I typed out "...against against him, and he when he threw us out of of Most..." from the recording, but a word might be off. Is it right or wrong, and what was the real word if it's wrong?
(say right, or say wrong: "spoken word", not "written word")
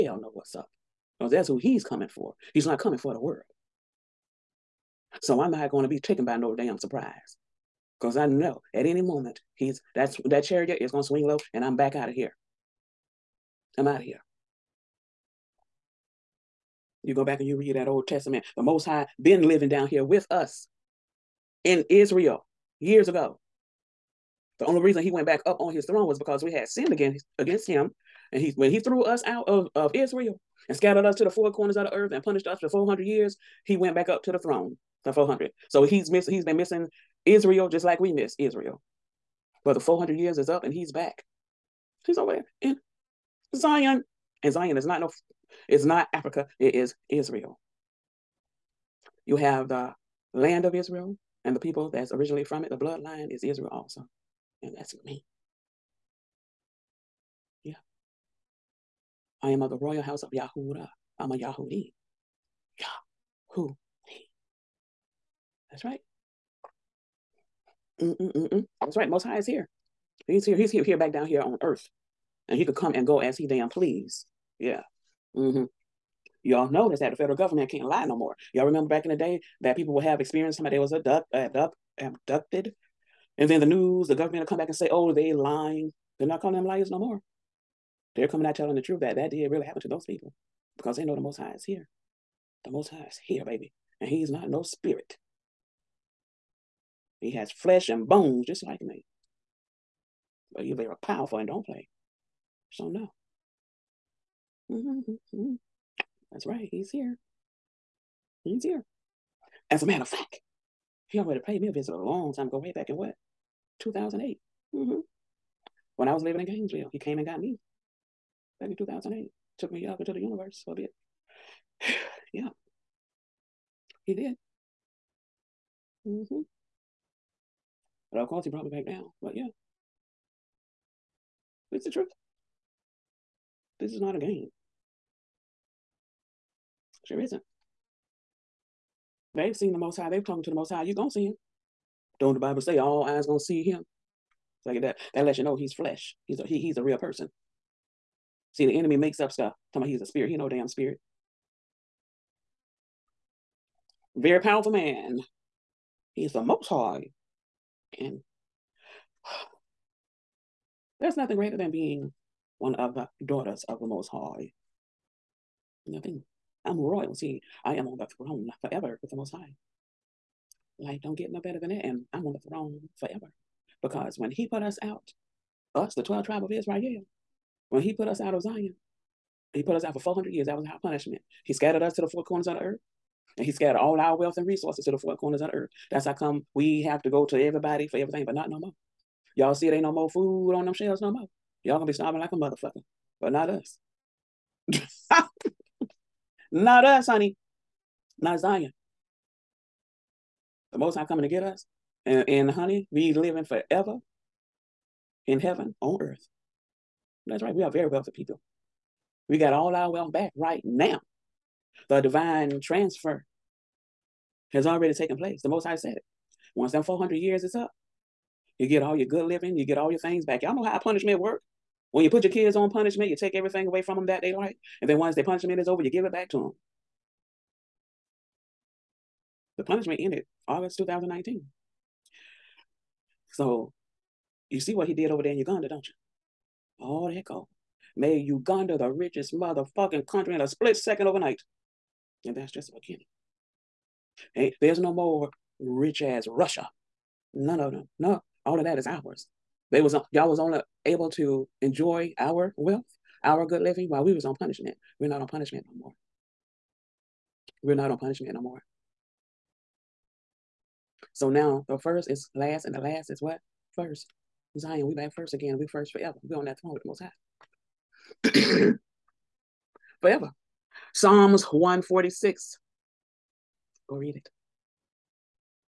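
wrong: "Israel", not "Most".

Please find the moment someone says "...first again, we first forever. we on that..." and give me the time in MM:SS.
04:25.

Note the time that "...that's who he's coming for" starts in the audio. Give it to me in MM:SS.
00:01.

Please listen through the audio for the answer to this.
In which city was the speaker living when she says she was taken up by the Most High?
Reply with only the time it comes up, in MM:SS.
01:56.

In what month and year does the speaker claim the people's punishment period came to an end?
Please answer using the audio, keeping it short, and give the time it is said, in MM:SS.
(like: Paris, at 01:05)
August 2019, at 03:50.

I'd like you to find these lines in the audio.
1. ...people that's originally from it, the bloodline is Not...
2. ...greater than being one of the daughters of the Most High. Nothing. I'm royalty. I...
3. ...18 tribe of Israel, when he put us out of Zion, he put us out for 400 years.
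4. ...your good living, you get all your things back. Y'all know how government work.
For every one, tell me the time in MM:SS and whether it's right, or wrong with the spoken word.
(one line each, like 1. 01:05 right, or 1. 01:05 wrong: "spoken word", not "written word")
1. 00:51 wrong: "Israel", not "Not"
2. 02:41 right
3. 02:56 wrong: "12", not "18"
4. 03:38 wrong: "punishment", not "government".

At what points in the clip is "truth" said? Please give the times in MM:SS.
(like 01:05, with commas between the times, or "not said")
01:28, 02:11.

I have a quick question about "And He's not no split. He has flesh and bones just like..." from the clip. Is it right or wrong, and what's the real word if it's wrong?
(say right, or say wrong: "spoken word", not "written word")
wrong: "spirit", not "split".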